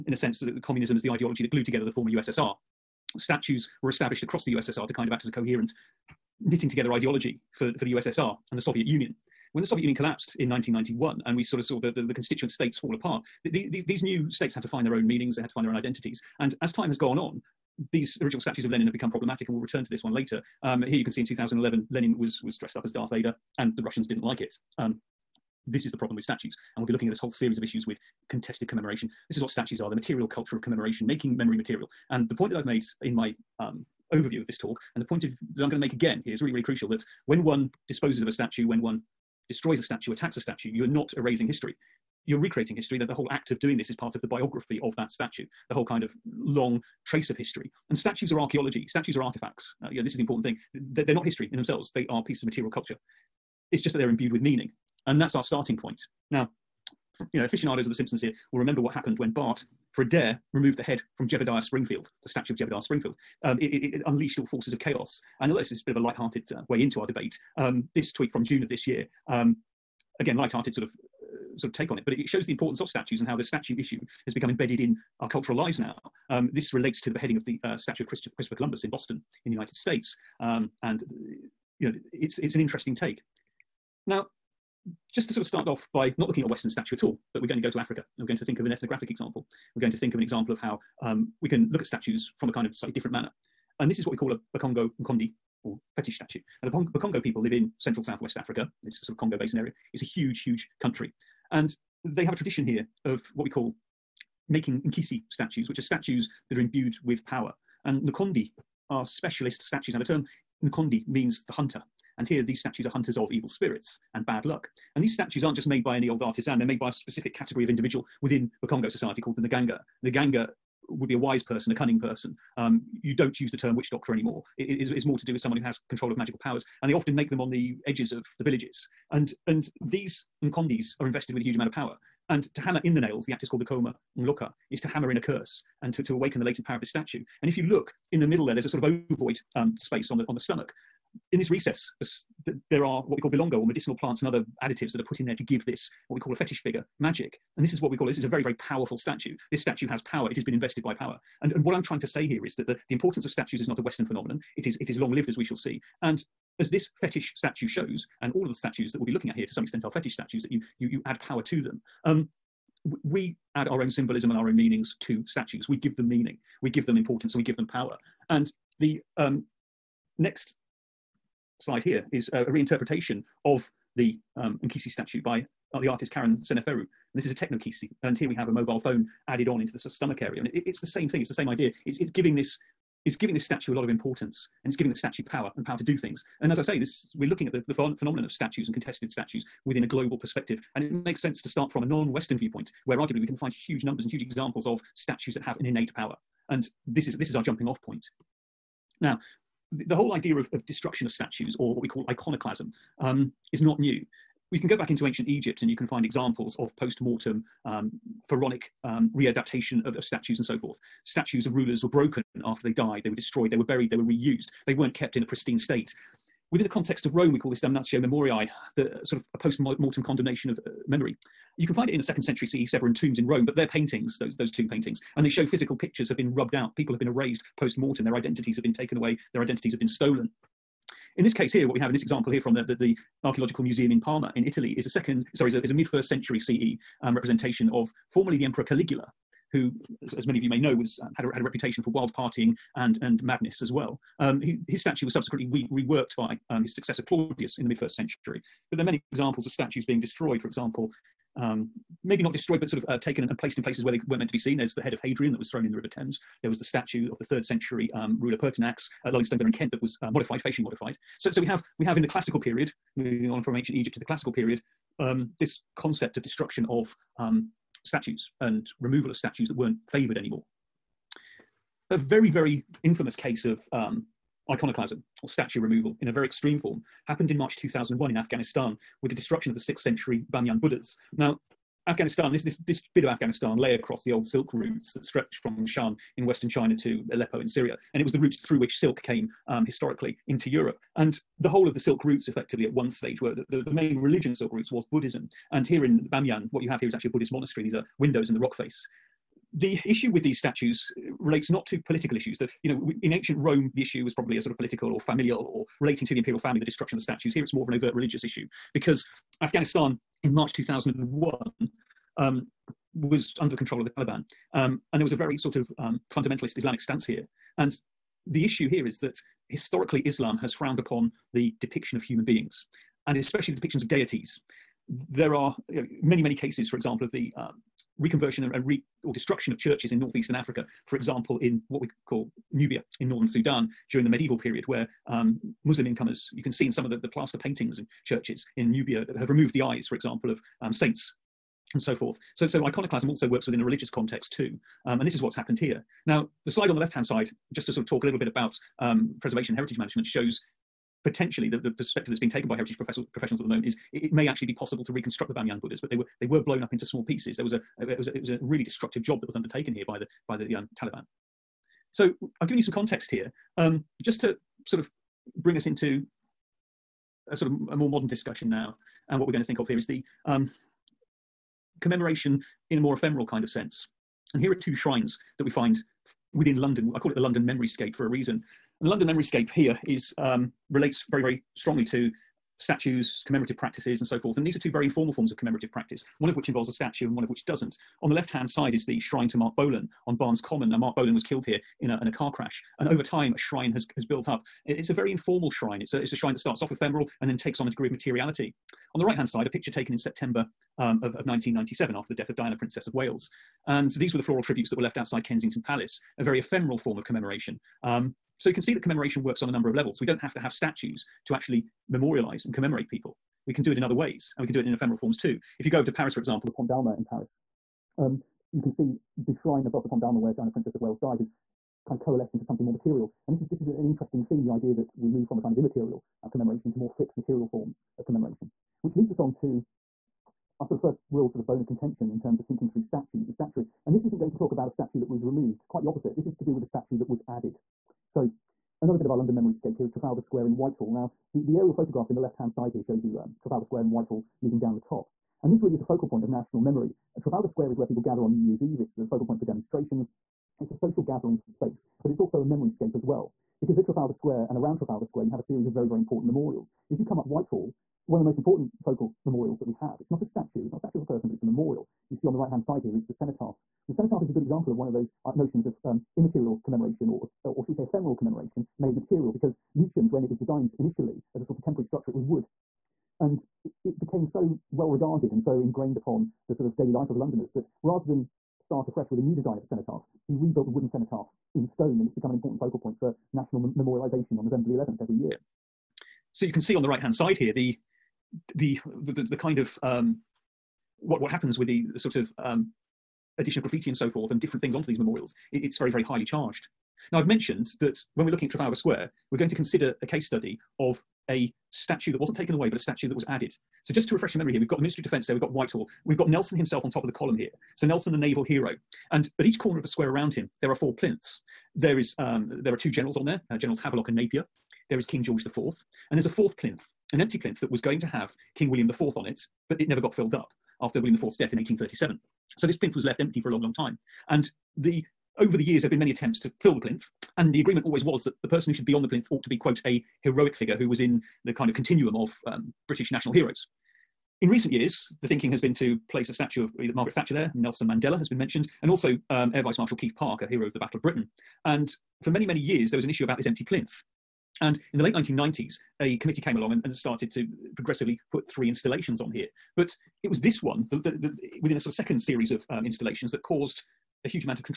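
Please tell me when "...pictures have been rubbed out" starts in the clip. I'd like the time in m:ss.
3:45.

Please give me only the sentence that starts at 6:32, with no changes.
And over time, a shrine has, has built up.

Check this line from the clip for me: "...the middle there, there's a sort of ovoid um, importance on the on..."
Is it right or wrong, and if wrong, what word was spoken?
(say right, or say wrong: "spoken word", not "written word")
wrong: "space", not "importance".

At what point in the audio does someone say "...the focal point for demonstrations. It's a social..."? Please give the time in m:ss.
7:28.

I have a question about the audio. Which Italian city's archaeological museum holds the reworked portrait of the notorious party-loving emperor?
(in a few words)
Parma.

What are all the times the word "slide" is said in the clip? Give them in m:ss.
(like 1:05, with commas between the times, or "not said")
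2:51, 5:46.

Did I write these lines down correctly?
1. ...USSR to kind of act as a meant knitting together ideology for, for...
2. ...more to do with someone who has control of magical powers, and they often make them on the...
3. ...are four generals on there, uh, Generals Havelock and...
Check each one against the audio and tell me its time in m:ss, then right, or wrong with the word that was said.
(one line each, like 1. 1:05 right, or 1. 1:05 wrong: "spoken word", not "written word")
1. 0:04 wrong: "coherent", not "meant"
2. 2:05 right
3. 8:32 wrong: "two", not "four".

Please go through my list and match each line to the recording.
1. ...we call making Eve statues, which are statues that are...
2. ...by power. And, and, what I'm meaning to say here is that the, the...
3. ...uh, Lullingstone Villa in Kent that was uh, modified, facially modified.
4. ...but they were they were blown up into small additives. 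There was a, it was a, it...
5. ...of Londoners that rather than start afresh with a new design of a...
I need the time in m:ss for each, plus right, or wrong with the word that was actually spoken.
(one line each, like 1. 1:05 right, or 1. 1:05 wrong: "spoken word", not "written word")
1. 1:43 wrong: "Nkisi", not "Eve"
2. 2:30 wrong: "trying", not "meaning"
3. 4:19 right
4. 5:55 wrong: "pieces", not "additives"
5. 7:57 right.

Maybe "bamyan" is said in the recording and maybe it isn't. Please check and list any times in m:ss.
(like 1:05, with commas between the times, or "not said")
4:56, 5:55.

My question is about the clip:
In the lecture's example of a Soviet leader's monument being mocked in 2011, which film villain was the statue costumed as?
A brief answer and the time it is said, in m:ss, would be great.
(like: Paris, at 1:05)
Darth Vader, at 0:22.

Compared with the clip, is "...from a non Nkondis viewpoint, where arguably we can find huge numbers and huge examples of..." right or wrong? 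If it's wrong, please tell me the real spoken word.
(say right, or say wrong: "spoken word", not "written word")
wrong: "Western", not "Nkondis".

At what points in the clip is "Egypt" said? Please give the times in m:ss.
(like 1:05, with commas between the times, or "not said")
3:25, 4:23.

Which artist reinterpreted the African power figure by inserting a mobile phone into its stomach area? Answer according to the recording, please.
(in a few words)
Karen Seneferu.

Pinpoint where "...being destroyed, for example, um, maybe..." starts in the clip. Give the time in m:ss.
4:09.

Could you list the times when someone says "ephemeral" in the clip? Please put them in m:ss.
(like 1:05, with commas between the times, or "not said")
6:12, 6:36, 6:46, 6:54, 7:47.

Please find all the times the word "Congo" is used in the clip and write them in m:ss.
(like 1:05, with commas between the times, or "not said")
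1:39, 1:58.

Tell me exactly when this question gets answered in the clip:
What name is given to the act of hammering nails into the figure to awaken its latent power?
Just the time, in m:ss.
2:13.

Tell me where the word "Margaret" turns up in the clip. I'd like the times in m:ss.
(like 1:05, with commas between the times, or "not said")
8:56.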